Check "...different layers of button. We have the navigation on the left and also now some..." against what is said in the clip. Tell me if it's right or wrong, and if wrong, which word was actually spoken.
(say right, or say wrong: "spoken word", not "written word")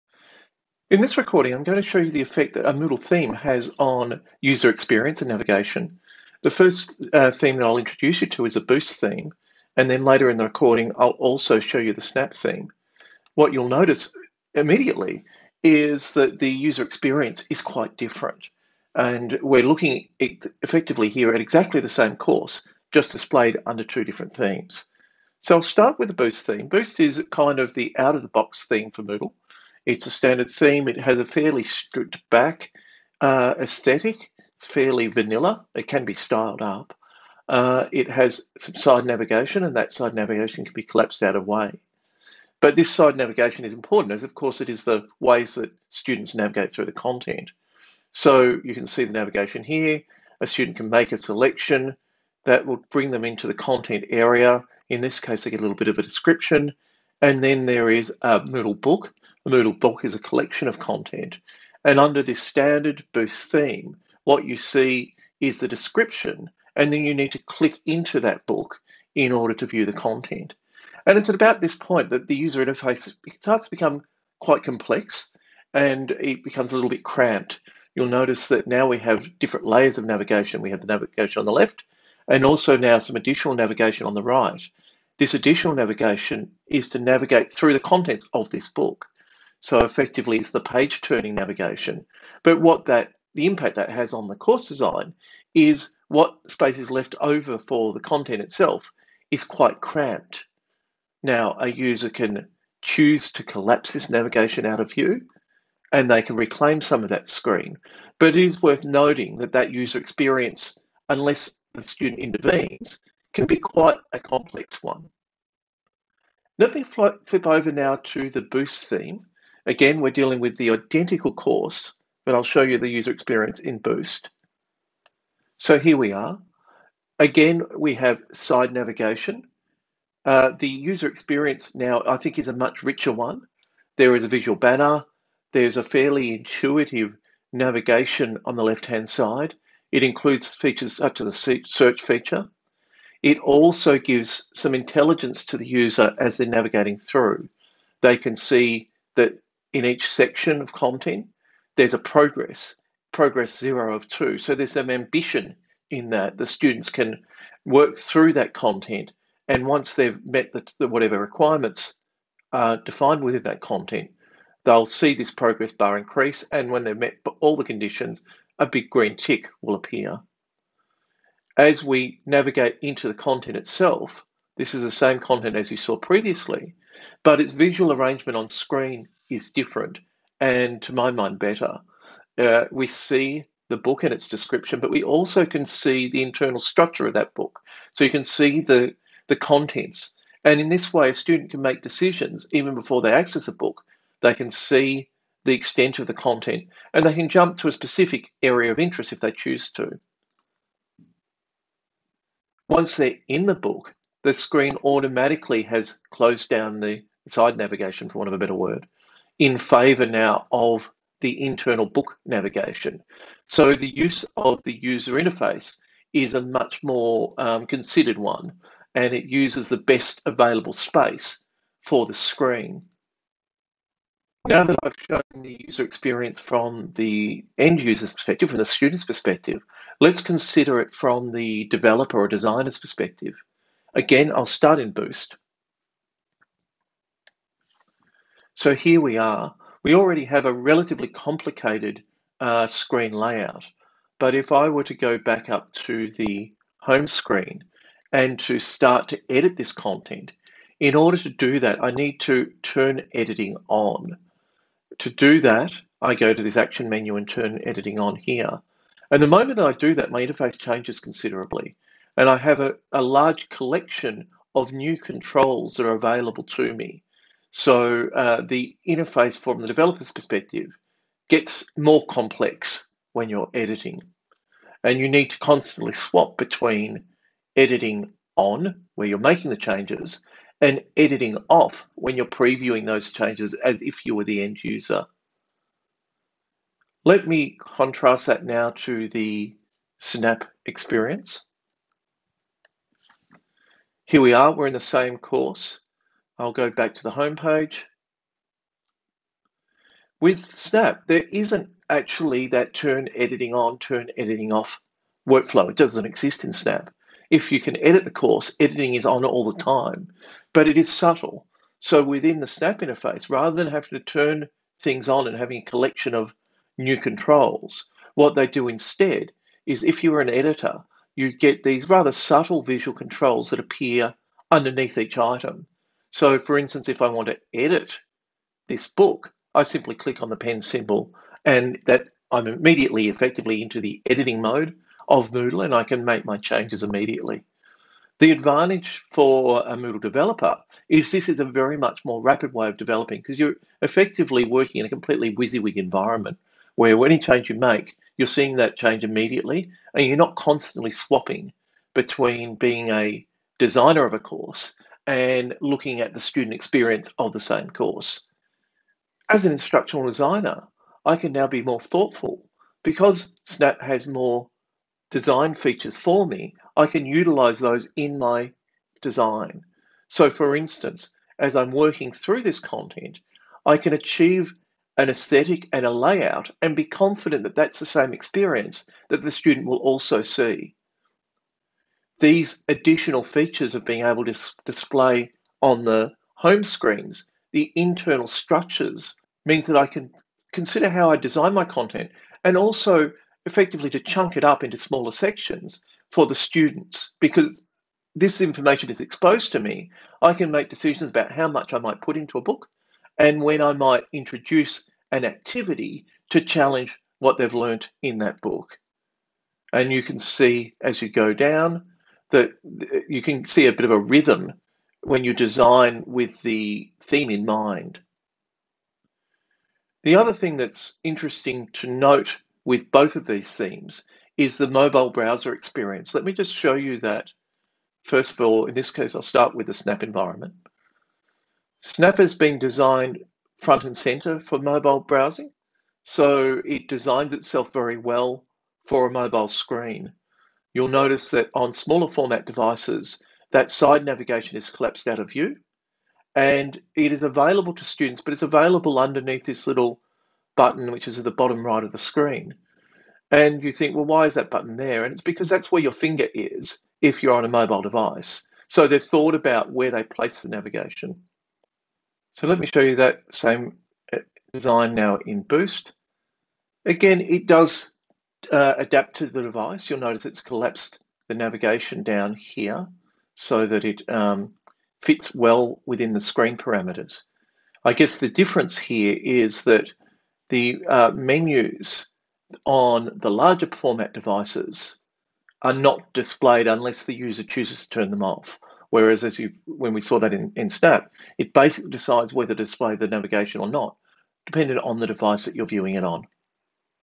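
wrong: "navigation", not "button".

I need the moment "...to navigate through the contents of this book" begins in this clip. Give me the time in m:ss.
1:26.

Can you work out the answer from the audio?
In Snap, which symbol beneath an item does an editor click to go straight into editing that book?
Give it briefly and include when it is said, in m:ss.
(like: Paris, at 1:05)
pen symbol, at 5:30.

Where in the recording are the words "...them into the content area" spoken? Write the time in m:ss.
0:53.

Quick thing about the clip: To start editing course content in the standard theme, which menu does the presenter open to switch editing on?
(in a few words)
action menu.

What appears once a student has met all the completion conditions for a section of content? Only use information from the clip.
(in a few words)
a big green tick.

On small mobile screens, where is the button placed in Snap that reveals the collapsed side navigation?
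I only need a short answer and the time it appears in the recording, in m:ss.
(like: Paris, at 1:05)
bottom right, at 7:31.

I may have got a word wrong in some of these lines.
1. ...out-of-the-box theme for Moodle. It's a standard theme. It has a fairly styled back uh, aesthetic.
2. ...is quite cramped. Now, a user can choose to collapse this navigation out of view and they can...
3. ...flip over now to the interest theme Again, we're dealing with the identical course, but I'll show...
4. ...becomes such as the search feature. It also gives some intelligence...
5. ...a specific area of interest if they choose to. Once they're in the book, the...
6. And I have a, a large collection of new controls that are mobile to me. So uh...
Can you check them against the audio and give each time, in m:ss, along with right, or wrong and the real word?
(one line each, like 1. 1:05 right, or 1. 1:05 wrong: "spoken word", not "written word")
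1. 0:27 wrong: "stripped", not "styled"
2. 1:39 right
3. 1:56 wrong: "boost", not "interest"
4. 2:20 wrong: "features", not "becomes"
5. 3:17 right
6. 4:22 wrong: "available", not "mobile".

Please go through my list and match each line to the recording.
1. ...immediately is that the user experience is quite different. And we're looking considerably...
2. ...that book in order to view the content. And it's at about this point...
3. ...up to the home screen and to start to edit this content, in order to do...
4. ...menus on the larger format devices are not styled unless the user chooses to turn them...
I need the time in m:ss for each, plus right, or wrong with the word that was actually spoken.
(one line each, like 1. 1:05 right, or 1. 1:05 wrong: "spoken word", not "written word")
1. 0:14 wrong: "effectively", not "considerably"
2. 1:08 right
3. 4:05 right
4. 8:01 wrong: "displayed", not "styled".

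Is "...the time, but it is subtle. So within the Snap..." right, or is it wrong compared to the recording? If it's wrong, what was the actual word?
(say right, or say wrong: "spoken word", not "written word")
right.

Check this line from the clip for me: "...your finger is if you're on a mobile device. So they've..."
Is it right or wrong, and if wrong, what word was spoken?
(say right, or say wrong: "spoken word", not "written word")
right.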